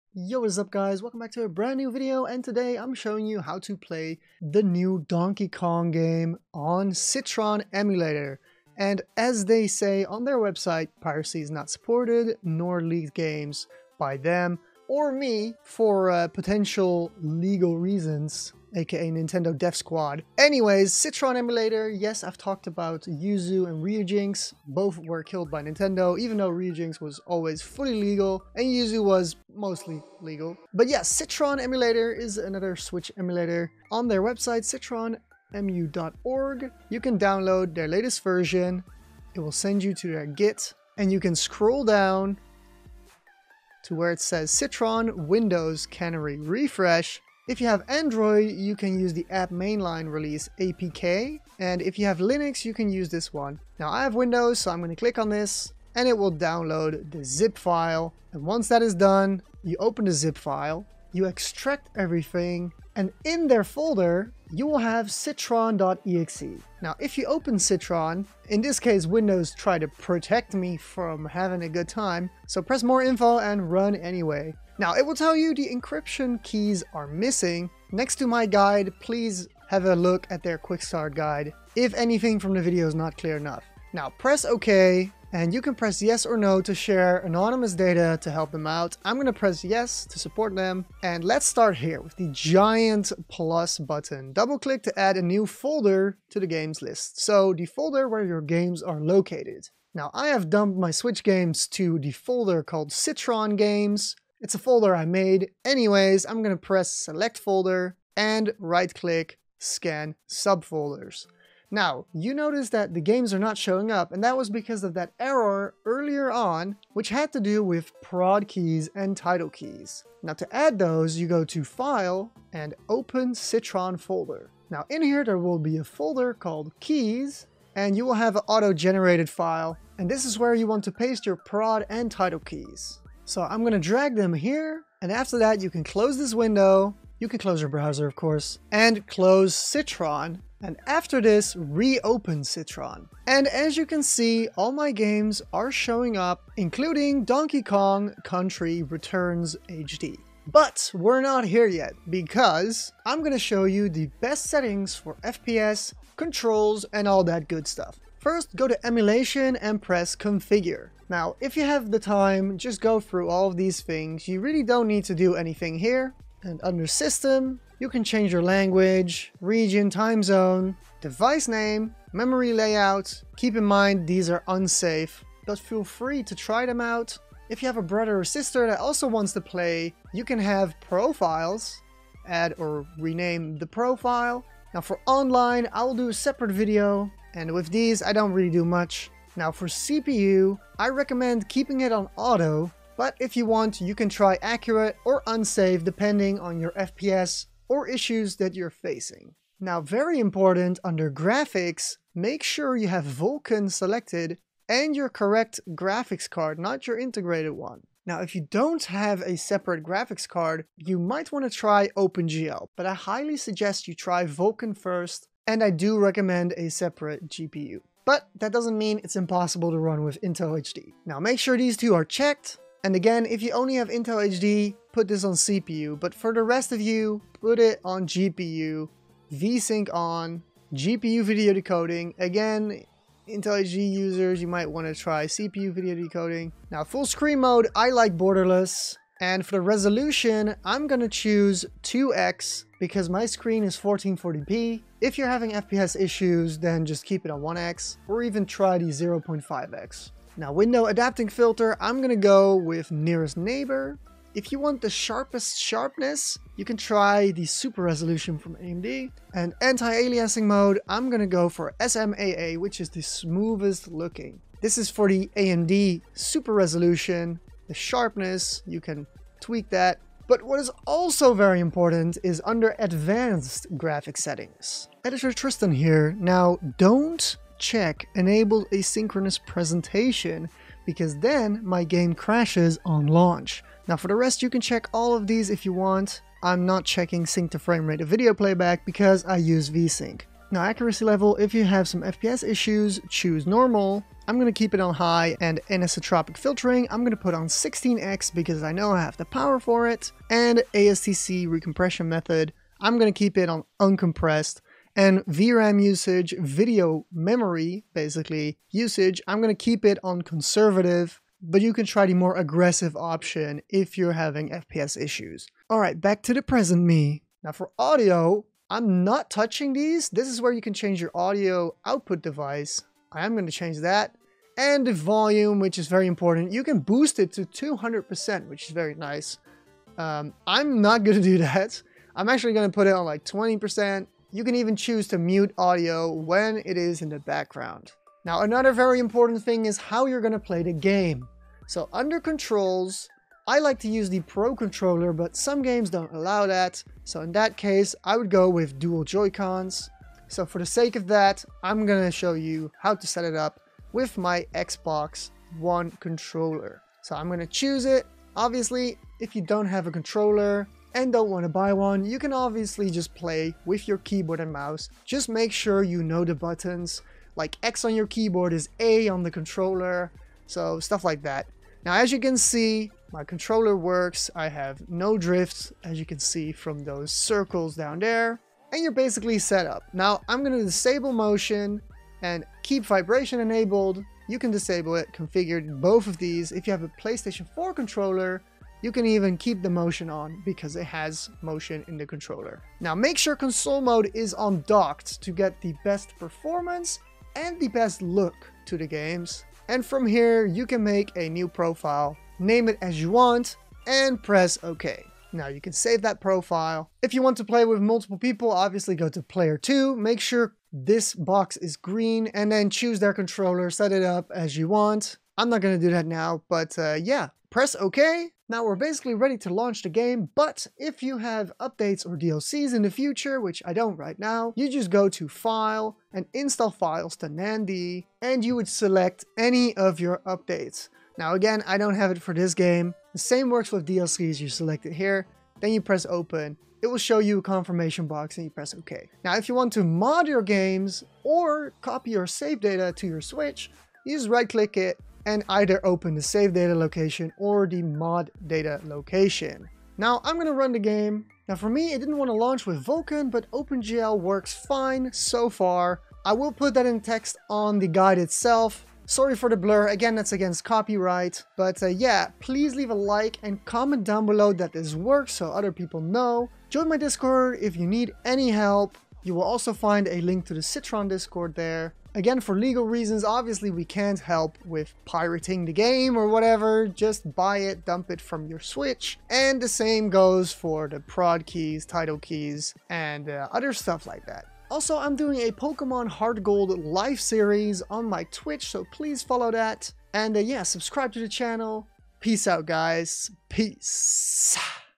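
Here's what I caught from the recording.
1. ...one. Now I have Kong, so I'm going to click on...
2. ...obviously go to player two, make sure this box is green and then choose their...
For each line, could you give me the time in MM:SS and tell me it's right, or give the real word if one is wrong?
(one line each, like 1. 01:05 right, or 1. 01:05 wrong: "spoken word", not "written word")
1. 00:53 wrong: "Windows", not "Kong"
2. 06:48 right.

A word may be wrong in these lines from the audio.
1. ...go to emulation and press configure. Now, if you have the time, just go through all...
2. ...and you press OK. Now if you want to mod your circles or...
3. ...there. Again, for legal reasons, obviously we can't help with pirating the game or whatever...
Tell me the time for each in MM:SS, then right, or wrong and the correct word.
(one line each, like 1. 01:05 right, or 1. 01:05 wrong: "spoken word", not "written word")
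1. 02:38 right
2. 07:18 wrong: "games", not "circles"
3. 07:51 right.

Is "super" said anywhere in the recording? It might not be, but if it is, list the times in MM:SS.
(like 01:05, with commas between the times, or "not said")
04:17, 04:26.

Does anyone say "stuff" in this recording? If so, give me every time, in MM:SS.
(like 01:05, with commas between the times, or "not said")
02:37, 06:10, 08:03.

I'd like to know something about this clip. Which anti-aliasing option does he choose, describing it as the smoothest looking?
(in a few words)
SMAA.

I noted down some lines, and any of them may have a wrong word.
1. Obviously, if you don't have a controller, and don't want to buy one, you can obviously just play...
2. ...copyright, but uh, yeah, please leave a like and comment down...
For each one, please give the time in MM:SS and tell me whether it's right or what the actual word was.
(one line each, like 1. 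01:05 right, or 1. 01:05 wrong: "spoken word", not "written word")
1. 05:58 right
2. 07:40 right.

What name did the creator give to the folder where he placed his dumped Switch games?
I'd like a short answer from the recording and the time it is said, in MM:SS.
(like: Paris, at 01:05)
Citron Games, at 01:42.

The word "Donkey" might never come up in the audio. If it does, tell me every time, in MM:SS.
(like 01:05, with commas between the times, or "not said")
00:05, 02:27.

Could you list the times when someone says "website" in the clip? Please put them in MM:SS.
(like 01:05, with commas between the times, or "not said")
00:10, 00:34.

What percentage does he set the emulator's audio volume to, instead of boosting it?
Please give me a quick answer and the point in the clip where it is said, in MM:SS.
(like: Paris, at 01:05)
20%, at 05:33.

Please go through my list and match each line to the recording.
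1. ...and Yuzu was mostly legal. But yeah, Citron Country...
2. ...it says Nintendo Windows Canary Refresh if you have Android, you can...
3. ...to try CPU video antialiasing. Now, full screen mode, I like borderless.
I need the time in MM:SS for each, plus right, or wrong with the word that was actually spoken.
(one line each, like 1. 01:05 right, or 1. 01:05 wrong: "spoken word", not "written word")
1. 00:28 wrong: "Emulator", not "Country"
2. 00:44 wrong: "Citron", not "Nintendo"
3. 03:54 wrong: "decoding", not "antialiasing".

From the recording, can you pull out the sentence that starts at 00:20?
Anyways, Citron Emulator, yes, I've talked about Yuzu and Ryujinx.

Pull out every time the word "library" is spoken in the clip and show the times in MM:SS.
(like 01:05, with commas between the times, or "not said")
not said.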